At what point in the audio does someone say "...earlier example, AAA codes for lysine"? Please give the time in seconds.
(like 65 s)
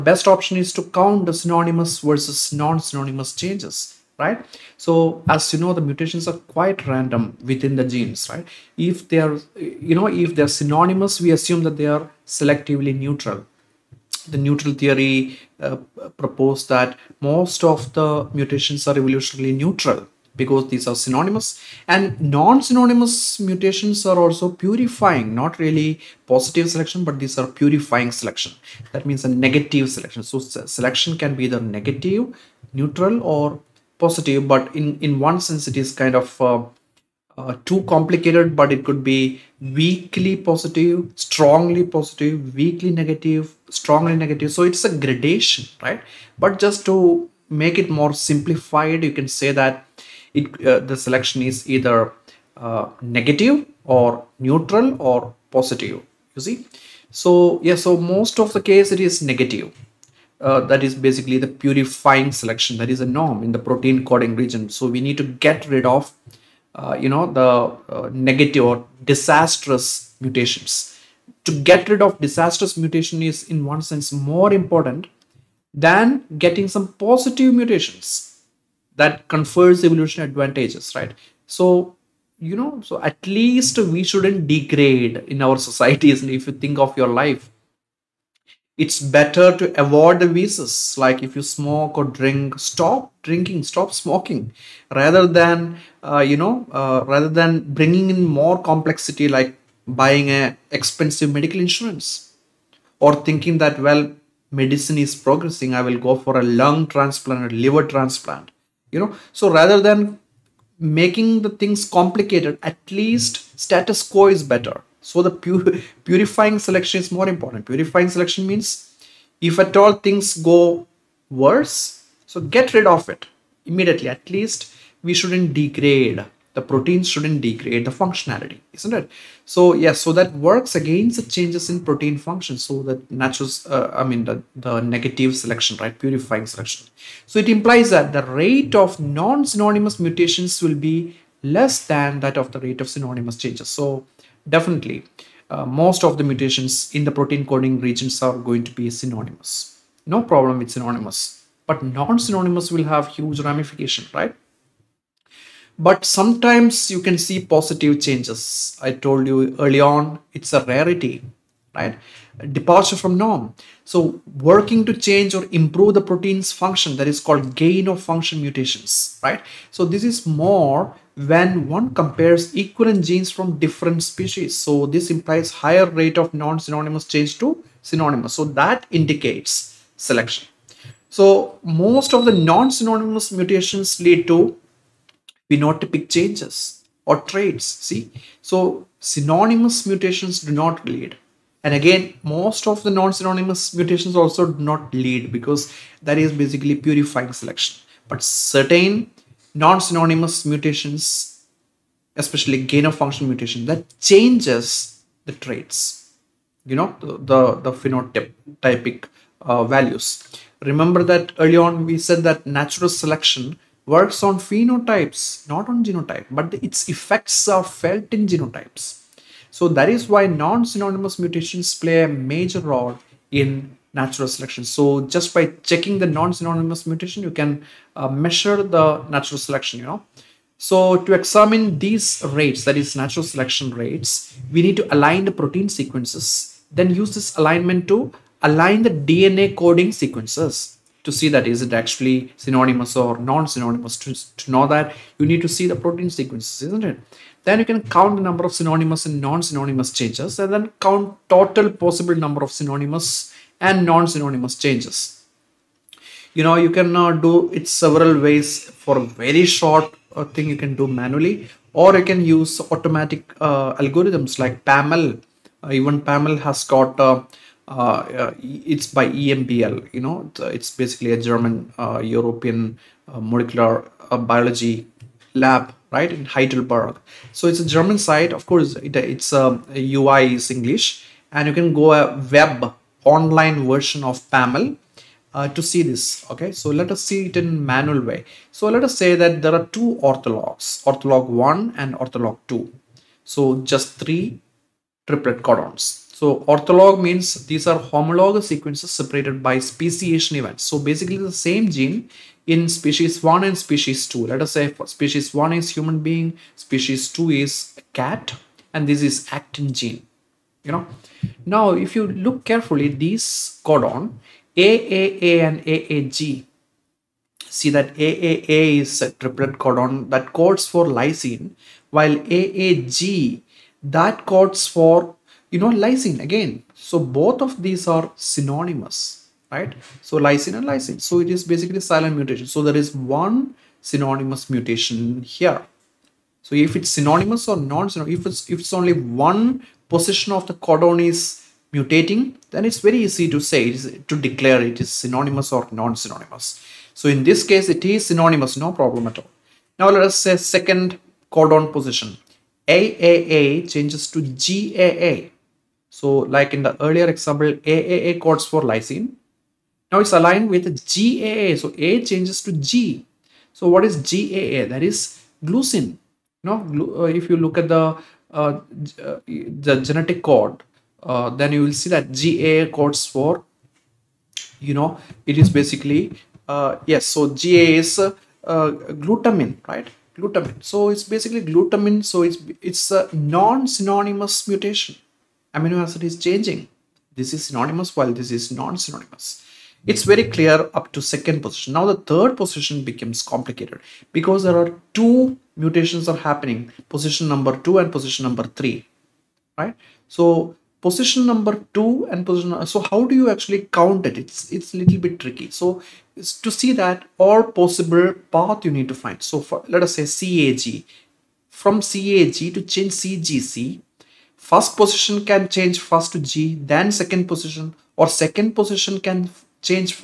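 356 s.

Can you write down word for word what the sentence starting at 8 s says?
If they are, you know, if they're synonymous, we assume that they are selectively neutral.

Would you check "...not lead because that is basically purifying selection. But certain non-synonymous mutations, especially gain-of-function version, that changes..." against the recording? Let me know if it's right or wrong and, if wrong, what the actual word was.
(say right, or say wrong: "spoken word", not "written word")
wrong: "mutation", not "version".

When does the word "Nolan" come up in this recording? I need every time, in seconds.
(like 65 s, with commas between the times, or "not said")
not said.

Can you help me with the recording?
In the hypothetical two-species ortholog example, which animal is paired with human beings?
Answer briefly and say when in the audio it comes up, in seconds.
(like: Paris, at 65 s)
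Cat, at 307 s.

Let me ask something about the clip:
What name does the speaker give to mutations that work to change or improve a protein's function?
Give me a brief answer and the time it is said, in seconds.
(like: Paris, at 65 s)
Gain of function mutations, at 167 s.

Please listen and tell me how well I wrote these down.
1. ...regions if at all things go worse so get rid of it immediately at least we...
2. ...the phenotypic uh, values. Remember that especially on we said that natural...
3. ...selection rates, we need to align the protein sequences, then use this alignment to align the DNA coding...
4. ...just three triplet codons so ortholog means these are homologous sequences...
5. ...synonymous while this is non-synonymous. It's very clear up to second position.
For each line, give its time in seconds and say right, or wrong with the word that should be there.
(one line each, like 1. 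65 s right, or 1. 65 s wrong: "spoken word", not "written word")
1. 118 s wrong: "means", not "regions"
2. 207 s wrong: "early", not "especially"
3. 233 s right
4. 293 s right
5. 387 s right.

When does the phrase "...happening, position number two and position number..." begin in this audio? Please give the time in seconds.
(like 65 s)
396 s.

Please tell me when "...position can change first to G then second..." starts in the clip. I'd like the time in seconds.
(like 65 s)
414 s.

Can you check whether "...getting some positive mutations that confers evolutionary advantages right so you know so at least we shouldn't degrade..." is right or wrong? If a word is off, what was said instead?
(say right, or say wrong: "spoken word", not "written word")
right.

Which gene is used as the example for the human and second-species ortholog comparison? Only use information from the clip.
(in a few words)
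Actin.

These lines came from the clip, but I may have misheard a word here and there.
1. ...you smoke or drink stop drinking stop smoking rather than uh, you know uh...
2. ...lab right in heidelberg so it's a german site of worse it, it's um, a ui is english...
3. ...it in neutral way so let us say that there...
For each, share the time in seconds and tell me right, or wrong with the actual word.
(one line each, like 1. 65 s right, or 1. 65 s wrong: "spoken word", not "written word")
1. 91 s right
2. 275 s wrong: "course", not "worse"
3. 287 s wrong: "manual", not "neutral".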